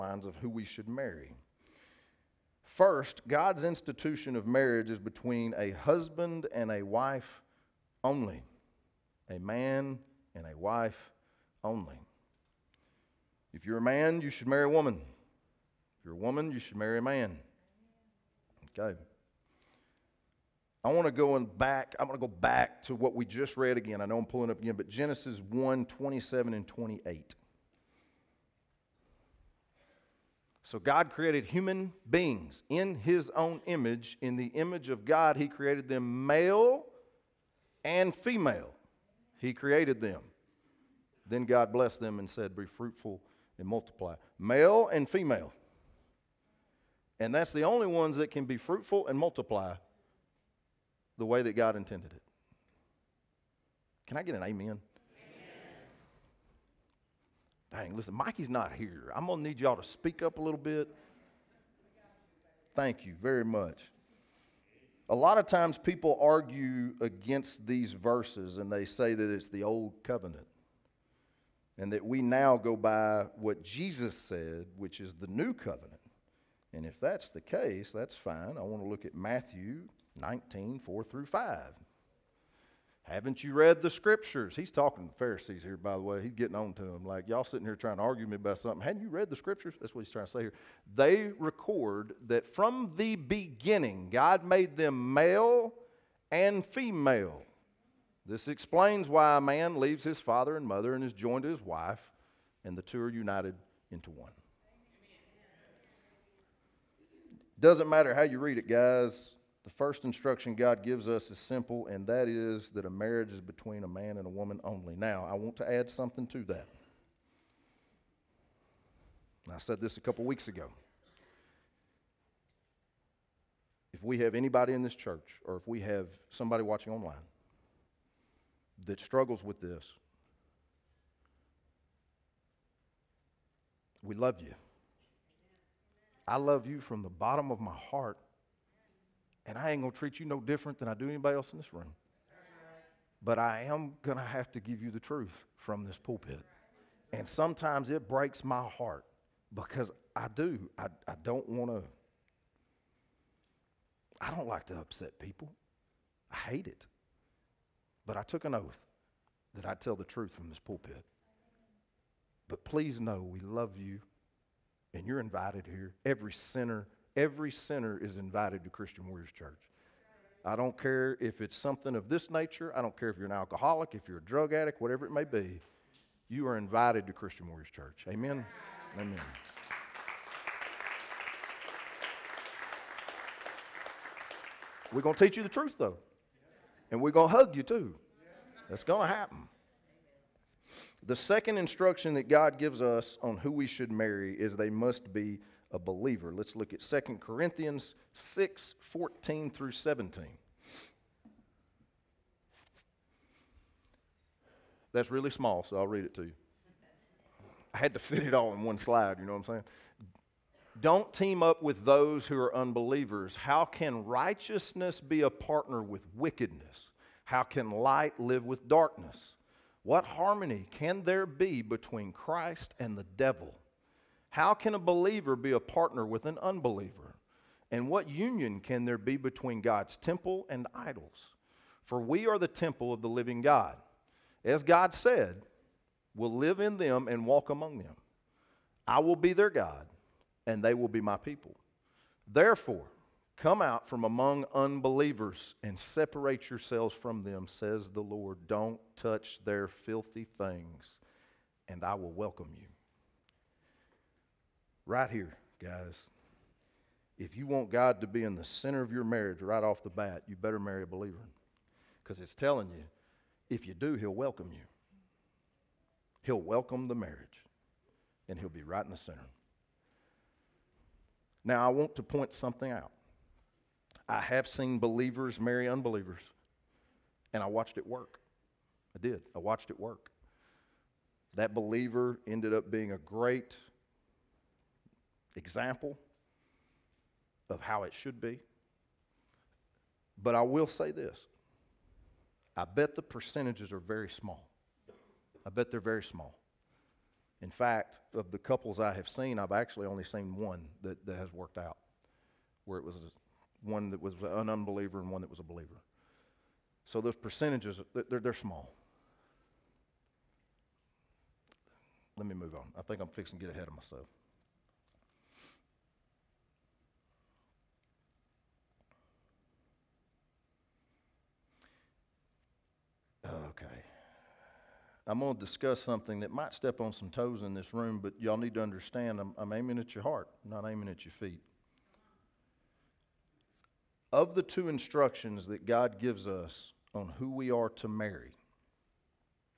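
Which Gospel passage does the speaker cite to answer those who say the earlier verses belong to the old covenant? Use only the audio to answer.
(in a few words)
Matthew 19:4-5.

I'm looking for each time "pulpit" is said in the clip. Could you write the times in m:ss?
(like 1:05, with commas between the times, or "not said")
2:25, 2:40.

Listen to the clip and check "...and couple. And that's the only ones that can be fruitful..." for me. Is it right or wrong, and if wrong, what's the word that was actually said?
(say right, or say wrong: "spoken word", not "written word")
wrong: "female", not "couple".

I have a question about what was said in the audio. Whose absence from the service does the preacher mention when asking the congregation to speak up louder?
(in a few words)
Mikey.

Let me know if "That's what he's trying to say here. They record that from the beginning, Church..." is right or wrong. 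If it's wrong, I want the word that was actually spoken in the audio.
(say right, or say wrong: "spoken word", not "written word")
wrong: "God", not "Church".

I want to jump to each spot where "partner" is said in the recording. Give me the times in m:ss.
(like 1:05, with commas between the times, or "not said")
3:35, 3:45.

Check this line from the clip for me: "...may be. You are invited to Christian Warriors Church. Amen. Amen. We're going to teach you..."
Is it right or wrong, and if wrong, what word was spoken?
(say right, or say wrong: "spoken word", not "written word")
right.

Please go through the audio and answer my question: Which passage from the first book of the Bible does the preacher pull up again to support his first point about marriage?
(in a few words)
Genesis 1:27-28.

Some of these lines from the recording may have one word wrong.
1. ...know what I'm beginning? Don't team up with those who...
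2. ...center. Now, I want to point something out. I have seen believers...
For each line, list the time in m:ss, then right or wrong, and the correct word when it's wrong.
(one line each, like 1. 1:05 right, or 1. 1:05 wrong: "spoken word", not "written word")
1. 3:29 wrong: "saying", not "beginning"
2. 4:28 right.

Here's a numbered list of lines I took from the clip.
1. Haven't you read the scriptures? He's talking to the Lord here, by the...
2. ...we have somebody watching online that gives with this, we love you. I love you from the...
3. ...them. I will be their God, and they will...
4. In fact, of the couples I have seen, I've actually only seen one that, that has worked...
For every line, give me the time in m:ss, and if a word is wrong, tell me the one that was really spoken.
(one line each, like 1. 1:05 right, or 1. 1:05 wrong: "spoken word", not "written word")
1. 1:23 wrong: "Pharisees", not "Lord"
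2. 2:05 wrong: "struggles", not "gives"
3. 3:57 right
4. 4:57 right.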